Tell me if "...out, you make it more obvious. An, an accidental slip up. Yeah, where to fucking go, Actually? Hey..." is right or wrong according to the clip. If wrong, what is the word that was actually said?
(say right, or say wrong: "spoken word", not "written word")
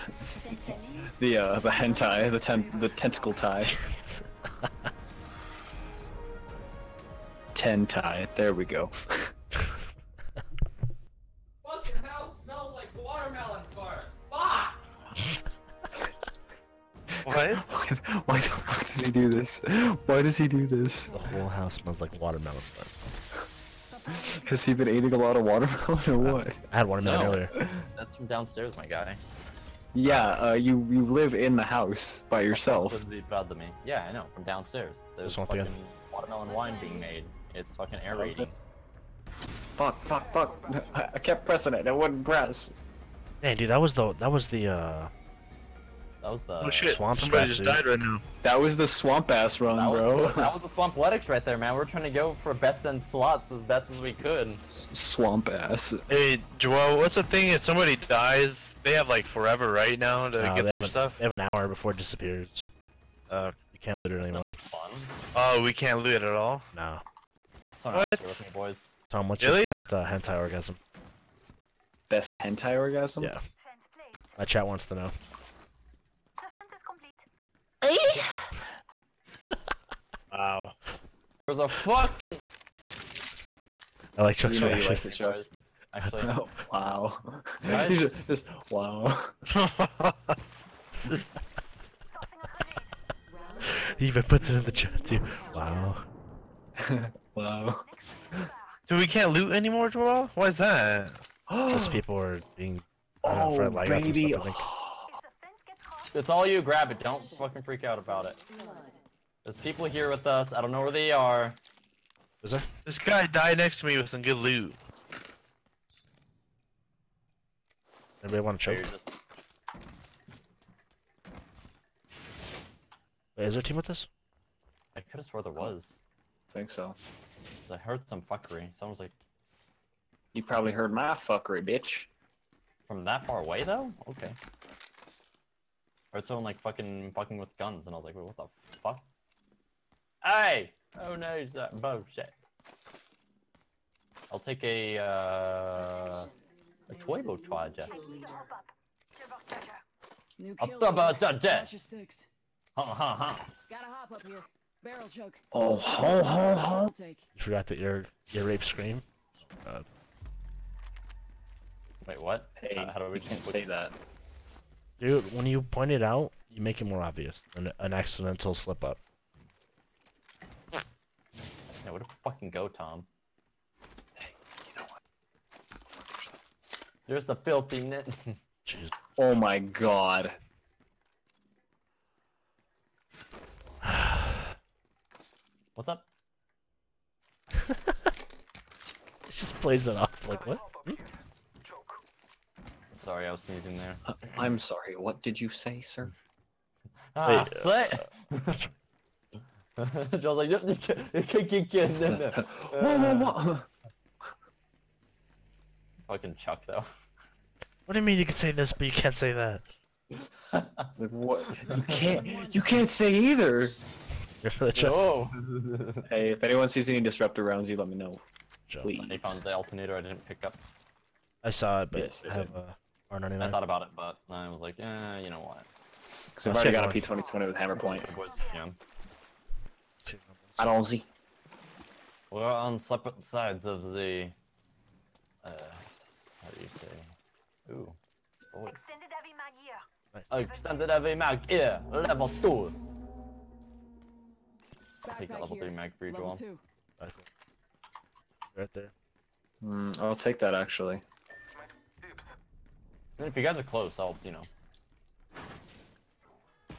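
wrong: "Tom", not "Actually".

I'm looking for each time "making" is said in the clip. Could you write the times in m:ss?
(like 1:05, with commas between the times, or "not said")
not said.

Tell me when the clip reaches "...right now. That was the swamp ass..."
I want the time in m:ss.
0:47.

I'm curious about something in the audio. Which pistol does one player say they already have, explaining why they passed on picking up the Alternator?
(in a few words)
P2020.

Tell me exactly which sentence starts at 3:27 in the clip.
What do you mean you can say this, but you can't say that?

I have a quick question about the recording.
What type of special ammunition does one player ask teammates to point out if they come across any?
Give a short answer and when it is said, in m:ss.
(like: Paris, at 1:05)
Disruptor rounds, at 3:37.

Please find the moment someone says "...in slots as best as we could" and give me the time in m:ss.
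0:52.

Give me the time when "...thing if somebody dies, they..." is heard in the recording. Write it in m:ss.
0:57.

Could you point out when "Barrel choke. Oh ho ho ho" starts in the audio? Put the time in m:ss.
2:34.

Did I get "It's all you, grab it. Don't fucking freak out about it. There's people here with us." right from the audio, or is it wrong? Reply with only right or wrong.
right.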